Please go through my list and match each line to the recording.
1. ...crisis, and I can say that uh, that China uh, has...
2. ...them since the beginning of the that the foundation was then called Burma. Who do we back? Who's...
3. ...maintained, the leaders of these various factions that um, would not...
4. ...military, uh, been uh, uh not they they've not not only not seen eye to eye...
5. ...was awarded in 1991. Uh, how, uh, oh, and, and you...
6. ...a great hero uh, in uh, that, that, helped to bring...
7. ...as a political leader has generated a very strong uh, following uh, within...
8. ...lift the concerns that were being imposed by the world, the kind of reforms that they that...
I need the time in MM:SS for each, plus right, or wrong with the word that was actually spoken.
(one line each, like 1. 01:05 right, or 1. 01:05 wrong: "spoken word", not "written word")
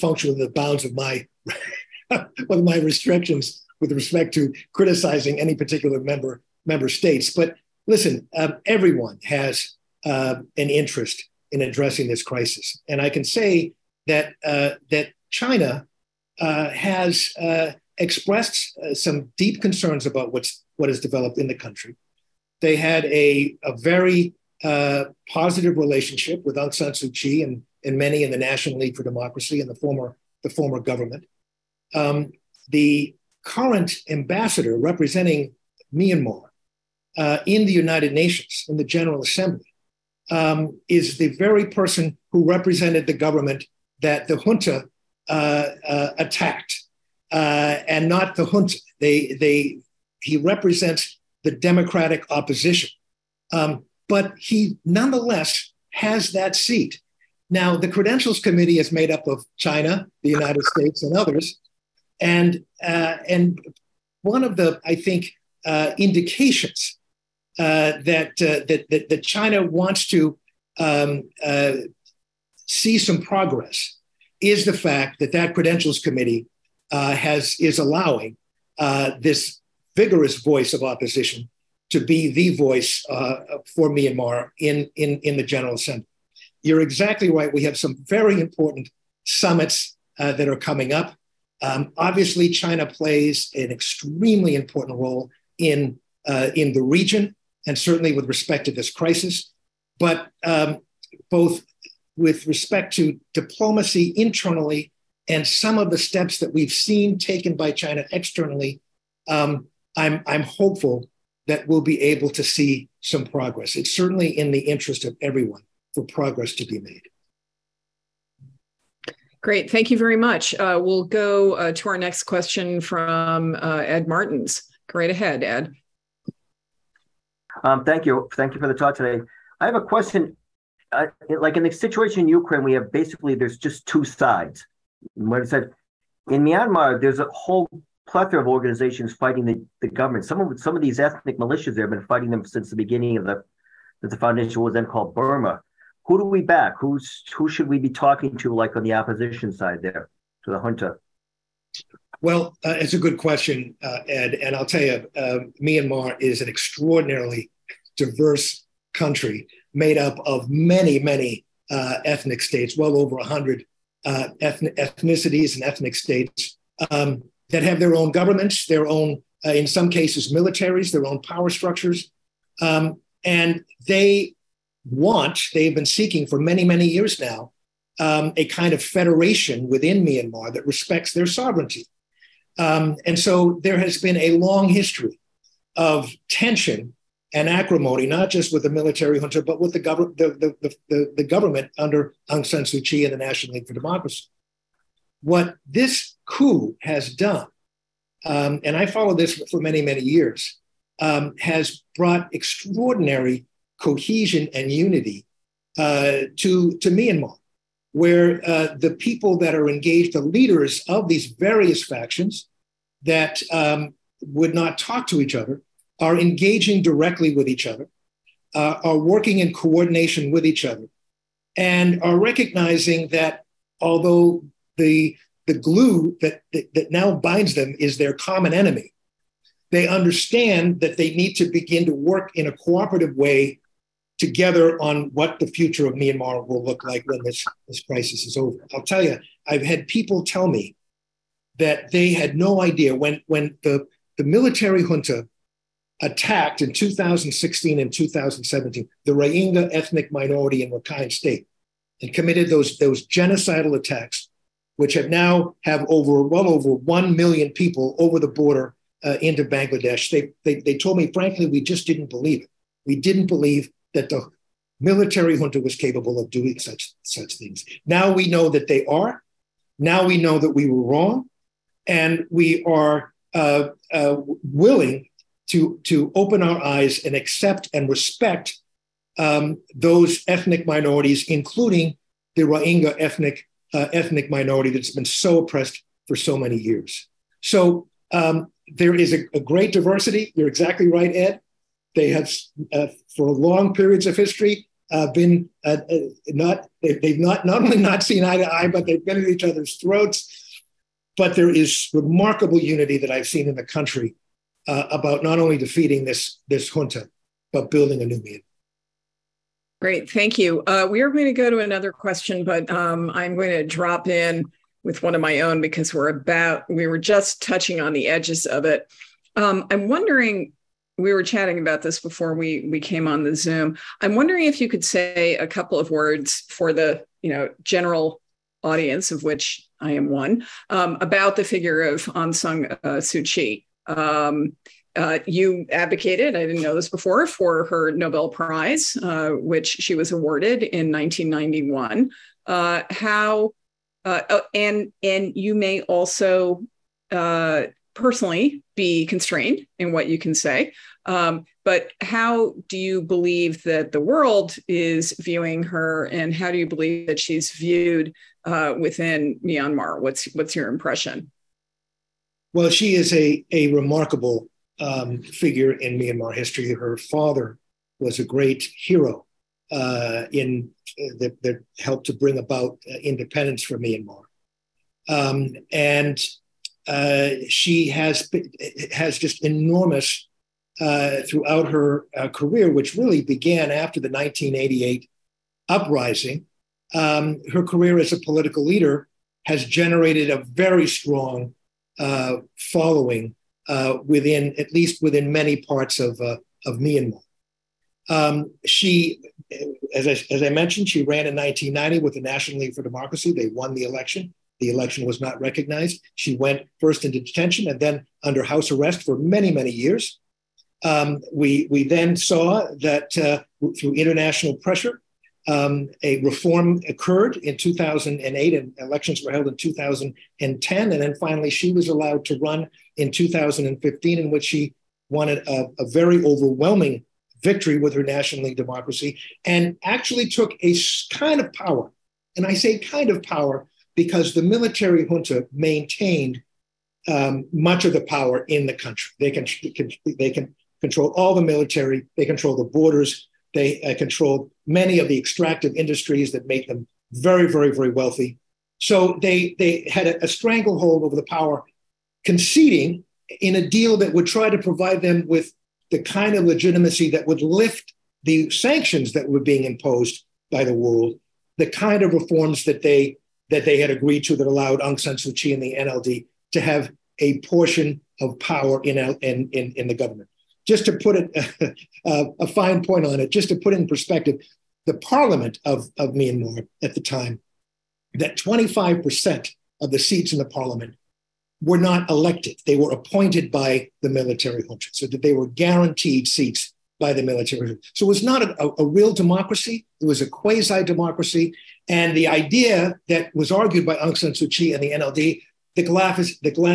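1. 00:12 right
2. 02:22 right
3. 03:29 wrong: "engaged", not "maintained"
4. 04:54 wrong: "history", not "military"
5. 05:39 right
6. 06:08 right
7. 06:27 right
8. 07:37 wrong: "sanctions", not "concerns".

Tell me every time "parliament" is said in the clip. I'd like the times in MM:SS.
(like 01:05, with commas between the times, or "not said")
07:54, 08:00.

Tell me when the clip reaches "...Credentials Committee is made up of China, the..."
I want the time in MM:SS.
00:57.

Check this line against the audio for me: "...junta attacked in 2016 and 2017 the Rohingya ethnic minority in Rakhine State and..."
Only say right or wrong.
right.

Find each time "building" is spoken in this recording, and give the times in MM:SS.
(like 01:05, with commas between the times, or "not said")
05:07.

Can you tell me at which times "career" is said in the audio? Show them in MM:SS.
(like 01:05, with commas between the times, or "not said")
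06:22, 06:27.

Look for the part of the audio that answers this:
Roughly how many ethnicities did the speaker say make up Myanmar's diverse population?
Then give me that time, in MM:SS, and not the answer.
02:42.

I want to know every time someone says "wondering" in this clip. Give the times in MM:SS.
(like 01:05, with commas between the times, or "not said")
05:19, 05:24.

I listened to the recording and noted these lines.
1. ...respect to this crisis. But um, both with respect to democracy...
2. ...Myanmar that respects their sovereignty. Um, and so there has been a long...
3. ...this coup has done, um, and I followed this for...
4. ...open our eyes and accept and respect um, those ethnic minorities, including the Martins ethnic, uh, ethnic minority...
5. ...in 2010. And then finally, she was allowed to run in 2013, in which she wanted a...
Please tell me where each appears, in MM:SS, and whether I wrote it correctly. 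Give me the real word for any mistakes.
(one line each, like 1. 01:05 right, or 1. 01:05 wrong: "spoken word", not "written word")
1. 01:38 wrong: "diplomacy", not "democracy"
2. 03:00 right
3. 03:15 right
4. 04:36 wrong: "Rohingya", not "Martins"
5. 06:59 wrong: "2015", not "2013".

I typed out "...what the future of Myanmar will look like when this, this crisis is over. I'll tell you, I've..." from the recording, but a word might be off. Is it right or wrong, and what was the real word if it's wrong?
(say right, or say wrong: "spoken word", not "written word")
right.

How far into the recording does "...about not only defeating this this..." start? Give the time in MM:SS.
05:04.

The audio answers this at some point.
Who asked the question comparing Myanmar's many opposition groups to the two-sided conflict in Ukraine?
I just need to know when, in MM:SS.
02:03.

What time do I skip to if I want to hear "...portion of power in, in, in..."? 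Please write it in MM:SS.
07:47.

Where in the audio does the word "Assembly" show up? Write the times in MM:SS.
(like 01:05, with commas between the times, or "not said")
00:39, 01:25.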